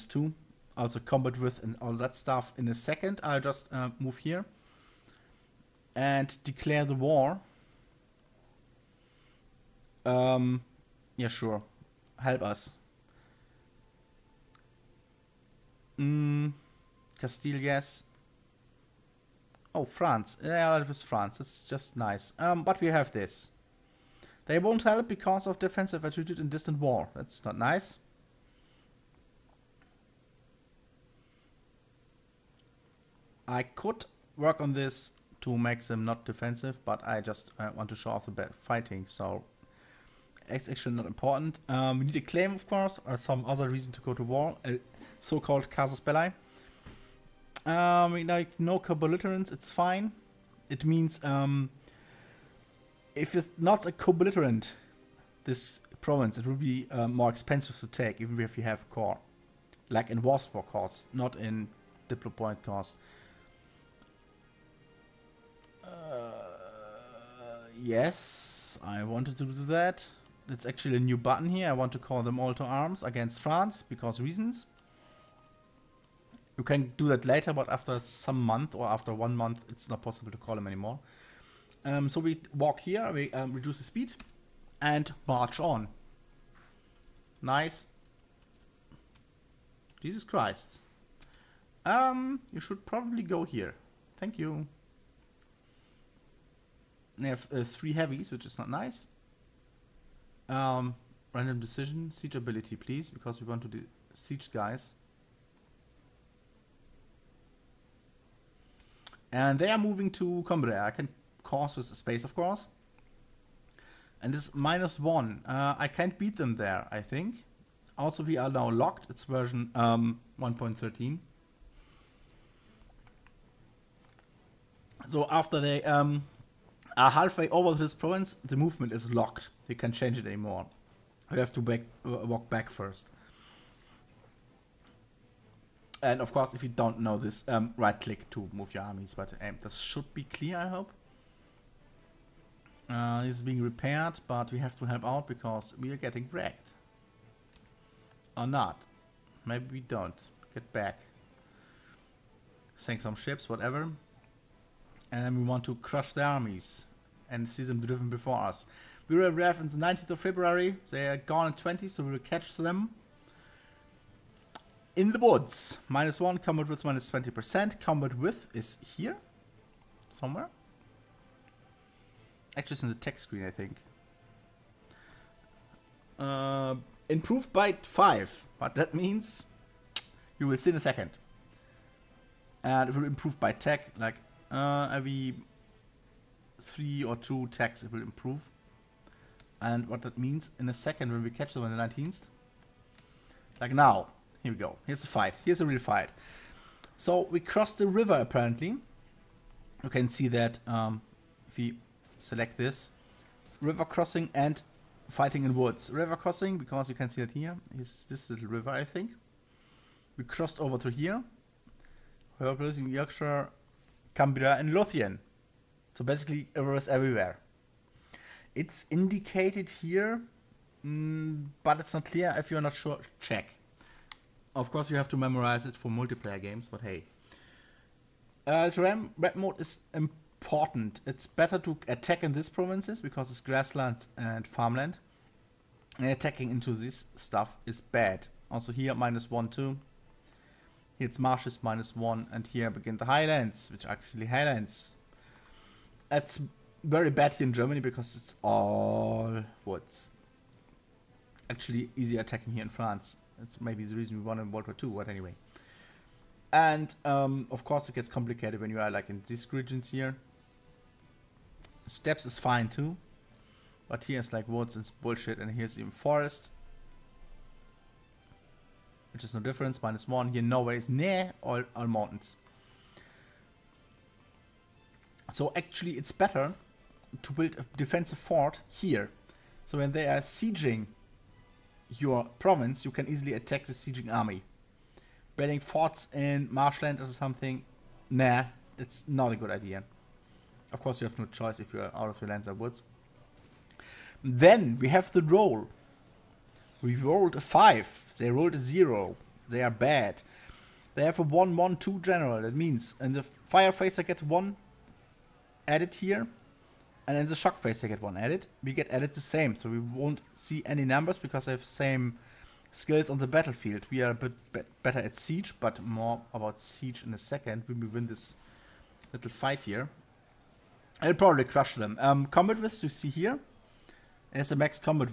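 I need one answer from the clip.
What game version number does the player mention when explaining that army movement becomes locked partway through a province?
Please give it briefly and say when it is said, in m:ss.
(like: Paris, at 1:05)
1.13, at 2:00.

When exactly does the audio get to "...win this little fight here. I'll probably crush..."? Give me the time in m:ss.
5:17.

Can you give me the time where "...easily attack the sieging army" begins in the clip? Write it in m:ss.
4:43.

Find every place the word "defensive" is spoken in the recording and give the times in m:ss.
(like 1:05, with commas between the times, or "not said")
0:25, 0:36, 4:37.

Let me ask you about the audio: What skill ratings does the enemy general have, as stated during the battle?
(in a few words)
1-1-2.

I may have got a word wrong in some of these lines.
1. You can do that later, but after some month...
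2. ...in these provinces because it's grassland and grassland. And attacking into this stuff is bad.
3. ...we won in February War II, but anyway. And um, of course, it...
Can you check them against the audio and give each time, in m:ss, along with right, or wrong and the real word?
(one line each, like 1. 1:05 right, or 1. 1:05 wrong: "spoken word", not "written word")
1. 1:16 right
2. 3:52 wrong: "farmland", not "grassland"
3. 4:14 wrong: "World", not "February".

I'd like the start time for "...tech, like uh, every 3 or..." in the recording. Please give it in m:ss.
3:03.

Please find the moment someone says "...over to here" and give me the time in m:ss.
3:30.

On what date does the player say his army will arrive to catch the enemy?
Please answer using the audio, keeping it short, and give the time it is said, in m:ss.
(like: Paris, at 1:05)
19th of February, at 2:39.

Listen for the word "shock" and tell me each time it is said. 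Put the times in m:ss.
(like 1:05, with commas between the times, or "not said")
5:07.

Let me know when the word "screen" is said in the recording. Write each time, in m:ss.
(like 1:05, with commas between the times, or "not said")
2:53.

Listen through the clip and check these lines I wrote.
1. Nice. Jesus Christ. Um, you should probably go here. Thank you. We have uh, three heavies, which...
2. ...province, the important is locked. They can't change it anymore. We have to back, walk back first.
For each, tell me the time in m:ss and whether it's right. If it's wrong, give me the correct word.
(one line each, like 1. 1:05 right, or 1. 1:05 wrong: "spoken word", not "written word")
1. 1:27 right
2. 2:07 wrong: "movement", not "important".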